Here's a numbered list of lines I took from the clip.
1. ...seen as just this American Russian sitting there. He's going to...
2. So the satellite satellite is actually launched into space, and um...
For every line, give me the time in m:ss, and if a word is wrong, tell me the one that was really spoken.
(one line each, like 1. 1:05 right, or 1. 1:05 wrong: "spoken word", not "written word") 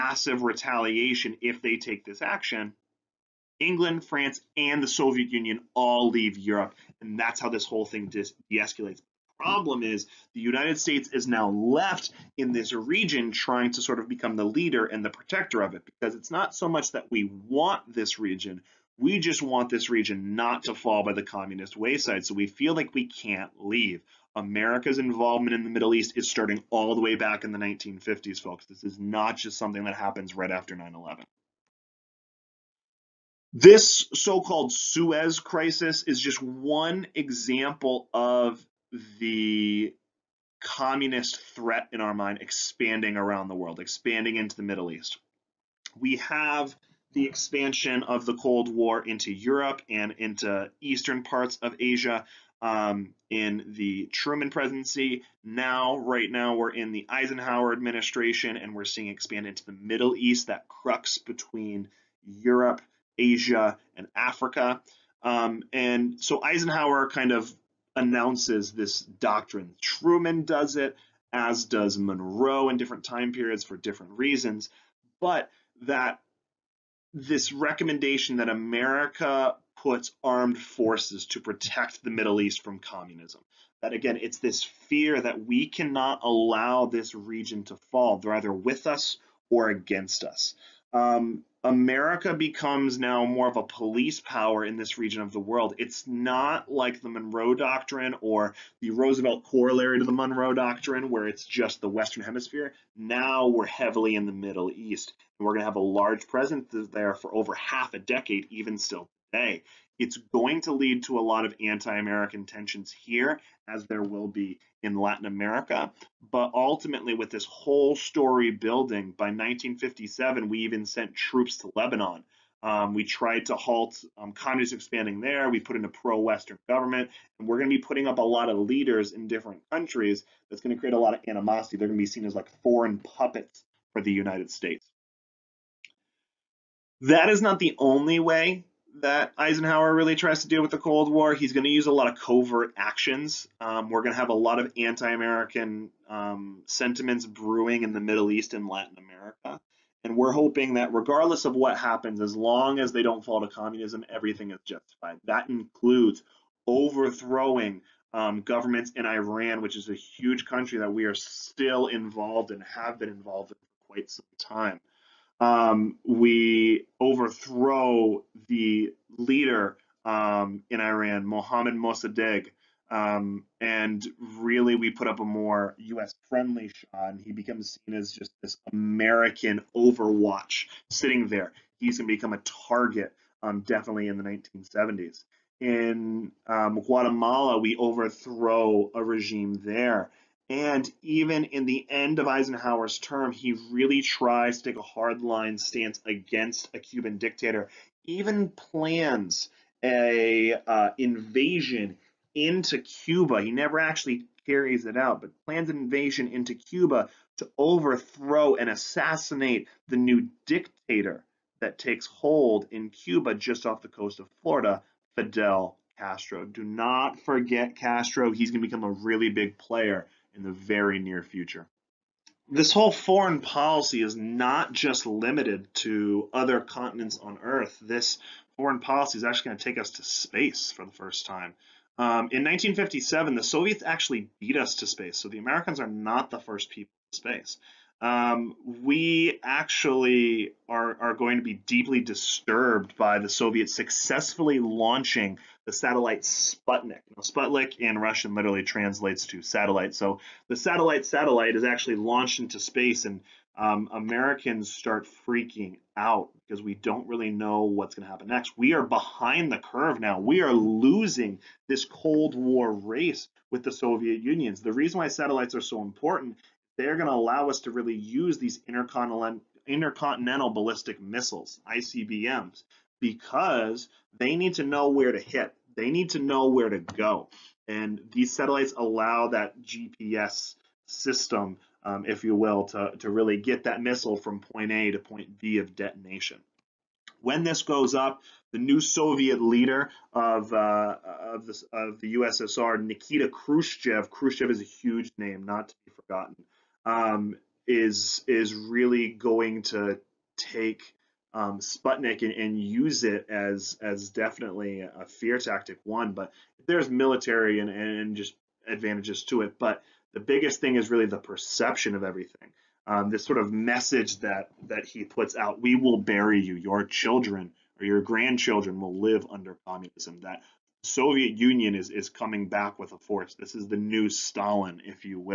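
1. 2:57 wrong: "Overwatch", not "Russian"
2. 4:09 right.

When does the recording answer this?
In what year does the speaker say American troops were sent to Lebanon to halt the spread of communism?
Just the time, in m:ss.
1:59.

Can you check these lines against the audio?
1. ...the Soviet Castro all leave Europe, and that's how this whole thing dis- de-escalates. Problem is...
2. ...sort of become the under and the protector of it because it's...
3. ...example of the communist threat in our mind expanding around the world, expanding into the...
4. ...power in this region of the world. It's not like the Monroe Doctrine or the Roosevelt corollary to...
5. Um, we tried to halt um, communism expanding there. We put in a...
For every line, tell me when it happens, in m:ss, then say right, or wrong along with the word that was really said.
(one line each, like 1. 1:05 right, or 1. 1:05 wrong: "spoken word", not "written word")
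1. 0:04 wrong: "Union", not "Castro"
2. 0:13 wrong: "leader", not "under"
3. 0:37 right
4. 1:34 right
5. 2:02 right.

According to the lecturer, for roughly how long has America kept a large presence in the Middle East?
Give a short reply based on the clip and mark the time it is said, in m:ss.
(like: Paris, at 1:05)
over half a decade, at 1:47.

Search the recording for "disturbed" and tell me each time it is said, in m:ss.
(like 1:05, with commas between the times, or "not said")
4:01.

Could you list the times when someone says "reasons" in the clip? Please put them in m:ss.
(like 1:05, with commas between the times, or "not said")
1:14, 4:24.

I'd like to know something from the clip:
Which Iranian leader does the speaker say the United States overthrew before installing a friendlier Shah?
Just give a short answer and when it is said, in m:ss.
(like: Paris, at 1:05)
Mohammad Mossadegh, at 2:51.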